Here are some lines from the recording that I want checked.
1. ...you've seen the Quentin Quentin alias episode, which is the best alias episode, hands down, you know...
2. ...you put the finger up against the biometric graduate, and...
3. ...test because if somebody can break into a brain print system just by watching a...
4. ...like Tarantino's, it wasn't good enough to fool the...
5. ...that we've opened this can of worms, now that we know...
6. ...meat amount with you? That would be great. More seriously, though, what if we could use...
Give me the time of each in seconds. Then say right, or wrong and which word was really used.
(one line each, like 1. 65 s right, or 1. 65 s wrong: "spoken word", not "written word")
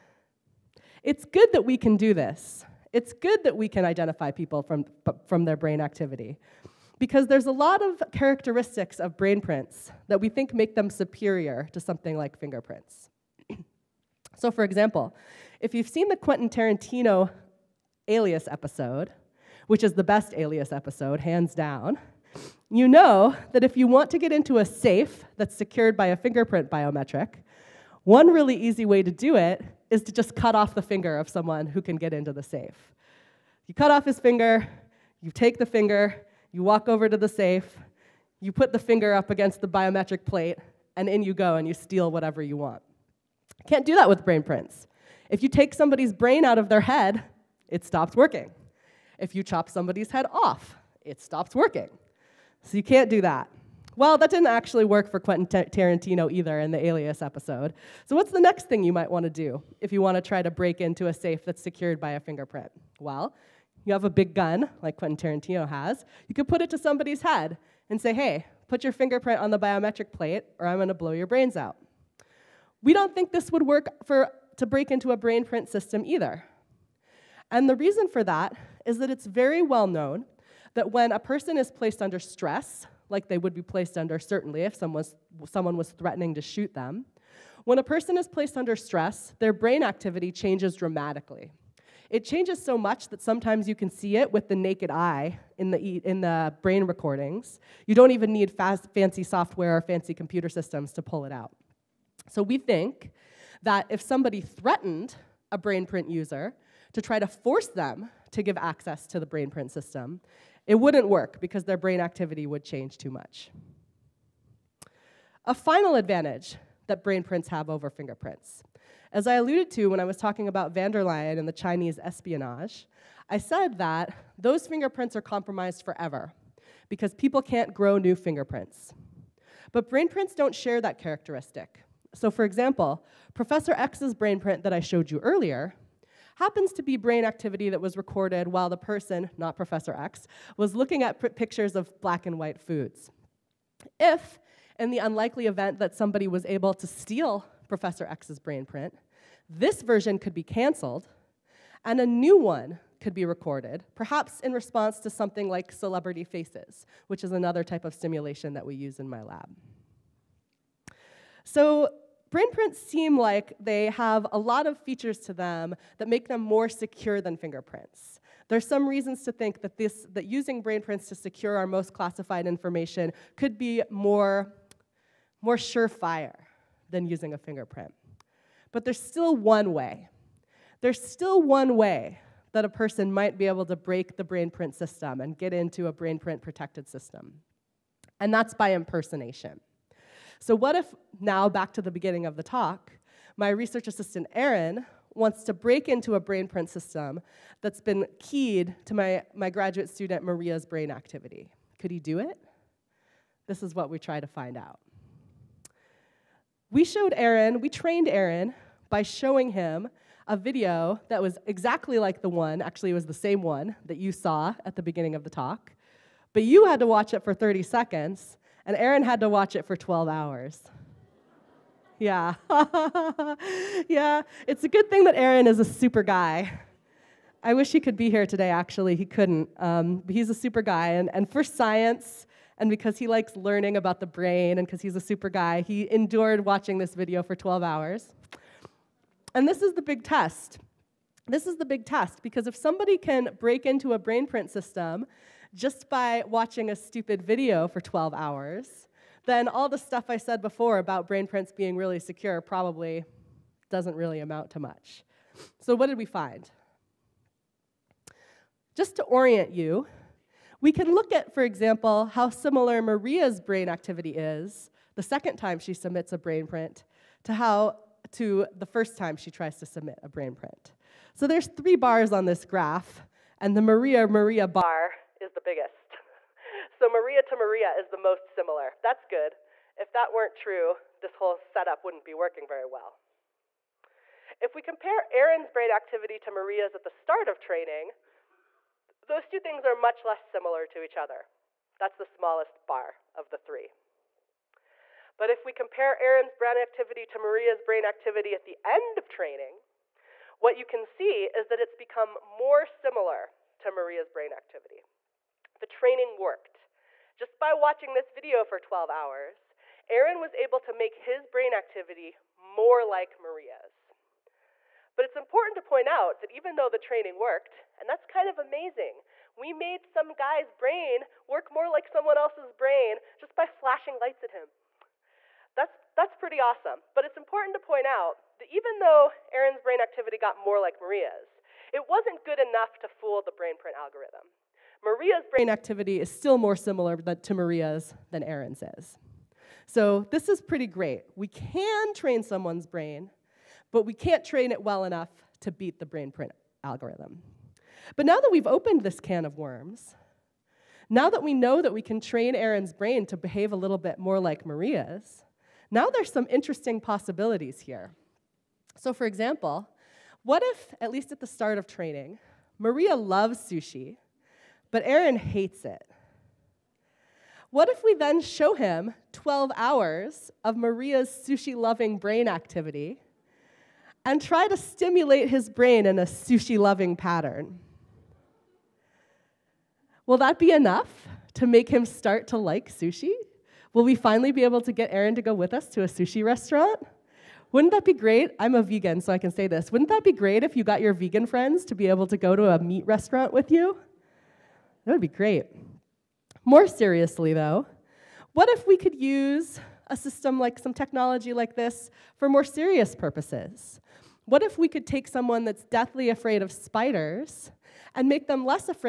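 1. 15 s wrong: "Tarantino", not "Quentin"
2. 38 s wrong: "plate", not "graduate"
3. 241 s right
4. 330 s wrong: "Maria", not "Tarantino"
5. 348 s right
6. 392 s wrong: "restaurant", not "amount".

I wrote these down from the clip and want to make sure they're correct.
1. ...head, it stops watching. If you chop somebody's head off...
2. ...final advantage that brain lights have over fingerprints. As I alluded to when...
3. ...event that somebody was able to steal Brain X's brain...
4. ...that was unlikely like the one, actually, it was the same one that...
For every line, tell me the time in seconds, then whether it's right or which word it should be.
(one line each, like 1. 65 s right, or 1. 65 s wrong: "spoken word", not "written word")
1. 46 s wrong: "working", not "watching"
2. 115 s wrong: "prints", not "lights"
3. 145 s wrong: "Professor", not "Brain"
4. 211 s wrong: "exactly", not "unlikely".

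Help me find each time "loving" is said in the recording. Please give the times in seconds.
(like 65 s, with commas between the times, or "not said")
371 s, 376 s.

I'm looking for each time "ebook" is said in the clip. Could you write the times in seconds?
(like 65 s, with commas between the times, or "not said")
not said.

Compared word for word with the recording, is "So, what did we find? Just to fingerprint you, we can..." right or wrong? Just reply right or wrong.
wrong.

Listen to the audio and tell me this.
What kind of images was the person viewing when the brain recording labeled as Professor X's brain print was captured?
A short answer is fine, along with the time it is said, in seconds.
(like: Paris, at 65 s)
black and white foods, at 142 s.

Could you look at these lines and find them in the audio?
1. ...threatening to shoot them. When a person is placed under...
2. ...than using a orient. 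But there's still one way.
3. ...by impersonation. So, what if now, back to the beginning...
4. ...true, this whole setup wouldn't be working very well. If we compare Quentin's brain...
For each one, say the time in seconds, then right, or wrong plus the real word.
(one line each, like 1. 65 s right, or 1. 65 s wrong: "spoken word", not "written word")
1. 85 s right
2. 176 s wrong: "fingerprint", not "orient"
3. 188 s right
4. 280 s wrong: "Aaron", not "Quentin".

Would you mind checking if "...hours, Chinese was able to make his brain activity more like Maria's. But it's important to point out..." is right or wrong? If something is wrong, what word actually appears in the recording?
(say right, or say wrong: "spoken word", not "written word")
wrong: "Aaron", not "Chinese".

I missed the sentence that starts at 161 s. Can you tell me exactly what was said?
So Brain prints seem like they have a lot of features to them that make them more secure than fingerprints.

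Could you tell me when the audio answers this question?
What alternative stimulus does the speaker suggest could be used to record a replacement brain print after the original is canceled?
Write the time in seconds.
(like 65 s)
155 s.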